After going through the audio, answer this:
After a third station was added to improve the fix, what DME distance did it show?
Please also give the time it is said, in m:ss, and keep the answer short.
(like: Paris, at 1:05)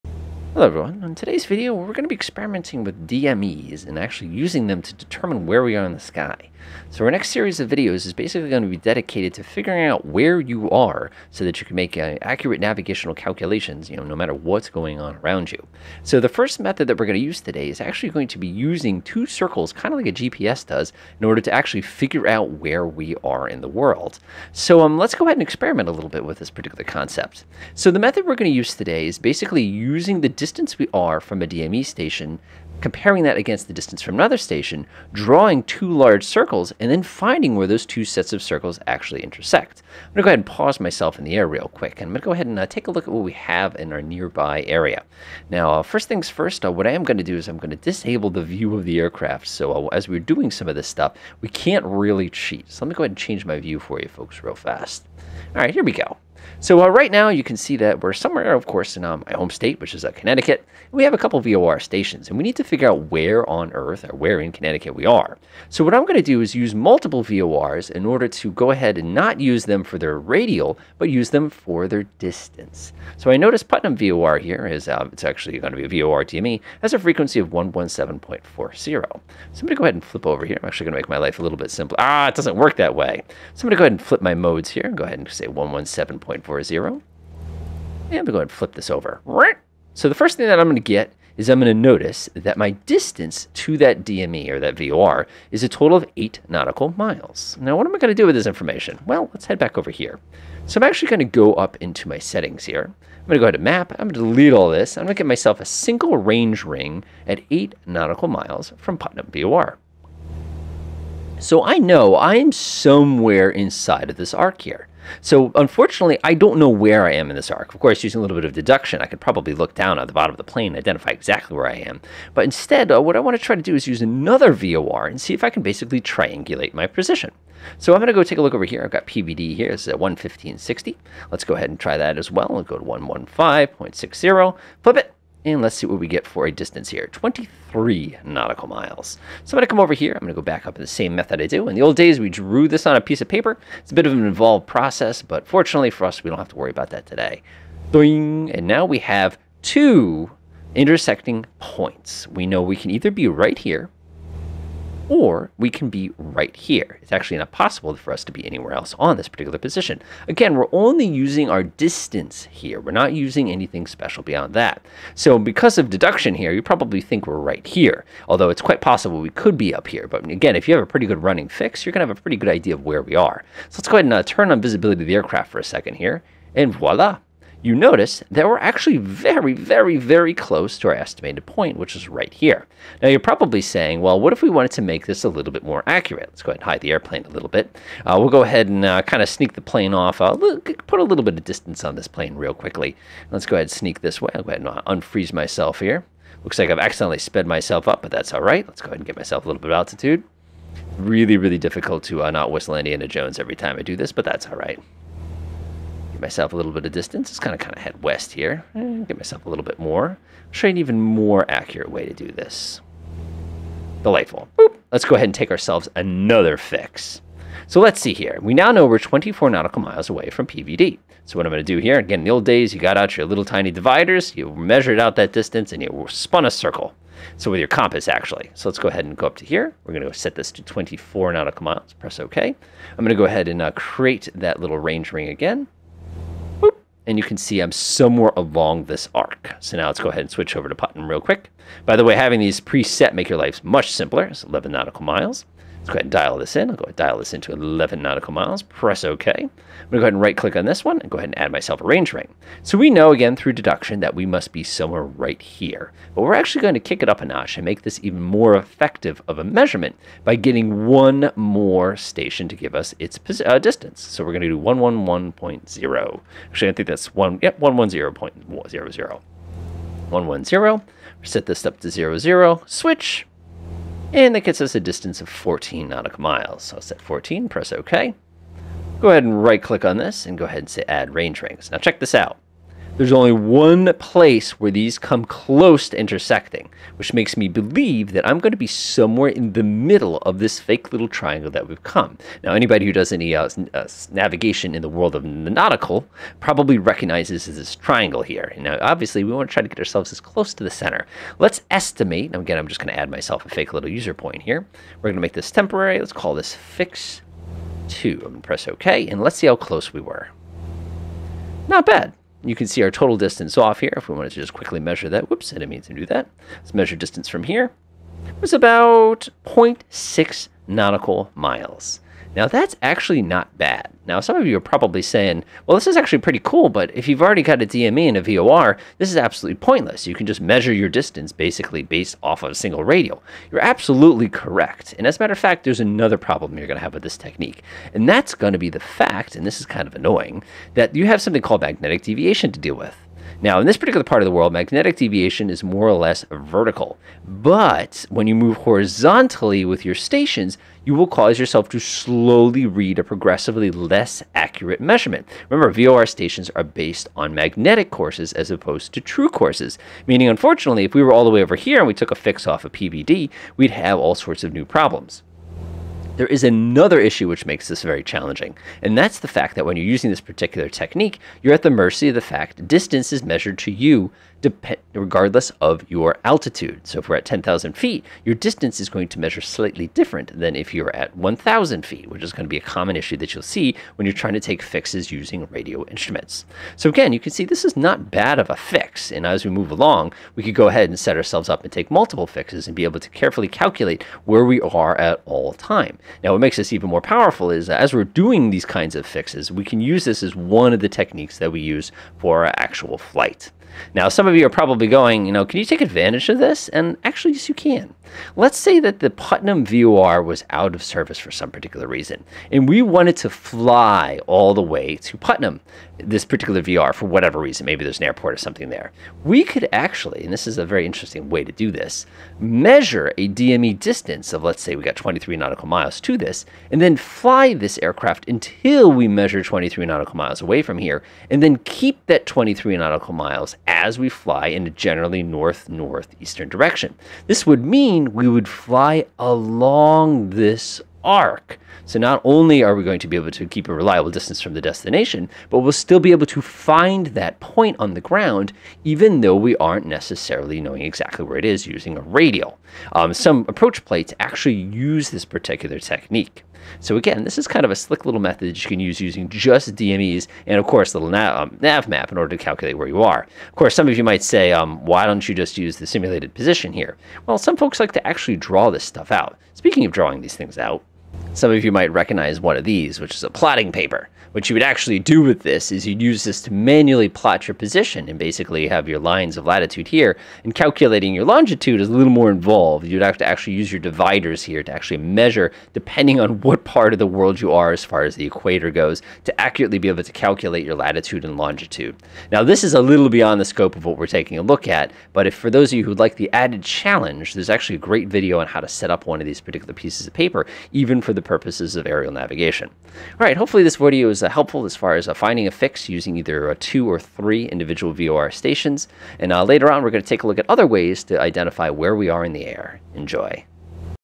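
14 nautical miles, at 4:35.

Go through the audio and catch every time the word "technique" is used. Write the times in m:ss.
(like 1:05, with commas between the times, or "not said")
5:37, 6:10, 6:40, 7:35.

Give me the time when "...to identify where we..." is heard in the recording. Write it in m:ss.
8:31.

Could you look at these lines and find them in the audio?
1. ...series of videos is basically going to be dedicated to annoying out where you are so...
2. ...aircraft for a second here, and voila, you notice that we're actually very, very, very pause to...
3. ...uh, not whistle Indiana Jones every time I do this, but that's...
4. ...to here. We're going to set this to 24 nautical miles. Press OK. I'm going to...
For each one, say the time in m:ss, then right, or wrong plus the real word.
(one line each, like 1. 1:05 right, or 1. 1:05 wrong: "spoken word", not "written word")
1. 0:07 wrong: "figuring", not "annoying"
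2. 2:55 wrong: "close", not "pause"
3. 3:22 right
4. 3:49 right.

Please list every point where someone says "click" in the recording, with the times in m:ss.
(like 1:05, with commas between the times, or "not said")
4:10, 4:39.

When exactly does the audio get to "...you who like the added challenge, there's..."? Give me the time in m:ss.
8:15.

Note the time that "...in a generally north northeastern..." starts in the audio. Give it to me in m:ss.
7:14.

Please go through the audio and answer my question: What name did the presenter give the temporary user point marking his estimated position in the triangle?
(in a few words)
fix 2.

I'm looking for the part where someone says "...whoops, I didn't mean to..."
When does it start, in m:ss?
5:15.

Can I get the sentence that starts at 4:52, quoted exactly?
Now, anybody who does any uh, uh, navigation in the world of the nautical probably recognizes this triangle here.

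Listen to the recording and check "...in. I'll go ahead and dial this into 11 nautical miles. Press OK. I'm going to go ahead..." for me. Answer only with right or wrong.
right.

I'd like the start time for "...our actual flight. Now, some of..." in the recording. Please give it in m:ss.
6:42.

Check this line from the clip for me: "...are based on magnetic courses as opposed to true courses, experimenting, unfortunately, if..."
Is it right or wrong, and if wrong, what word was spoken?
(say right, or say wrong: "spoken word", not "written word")
wrong: "meaning", not "experimenting".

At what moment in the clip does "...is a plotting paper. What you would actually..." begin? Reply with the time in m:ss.
7:53.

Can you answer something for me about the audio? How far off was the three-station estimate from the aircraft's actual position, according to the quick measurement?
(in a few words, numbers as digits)
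0.6 nautical miles.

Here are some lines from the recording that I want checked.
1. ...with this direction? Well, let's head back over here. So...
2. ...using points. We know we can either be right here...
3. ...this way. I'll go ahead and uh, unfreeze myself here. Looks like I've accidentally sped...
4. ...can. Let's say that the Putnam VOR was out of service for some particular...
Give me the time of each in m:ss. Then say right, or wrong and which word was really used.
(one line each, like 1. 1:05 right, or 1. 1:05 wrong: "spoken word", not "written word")
1. 1:38 wrong: "information", not "direction"
2. 2:30 wrong: "intersecting", not "using"
3. 3:14 right
4. 6:47 right.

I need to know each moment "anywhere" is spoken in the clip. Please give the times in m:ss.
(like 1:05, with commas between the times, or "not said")
2:38.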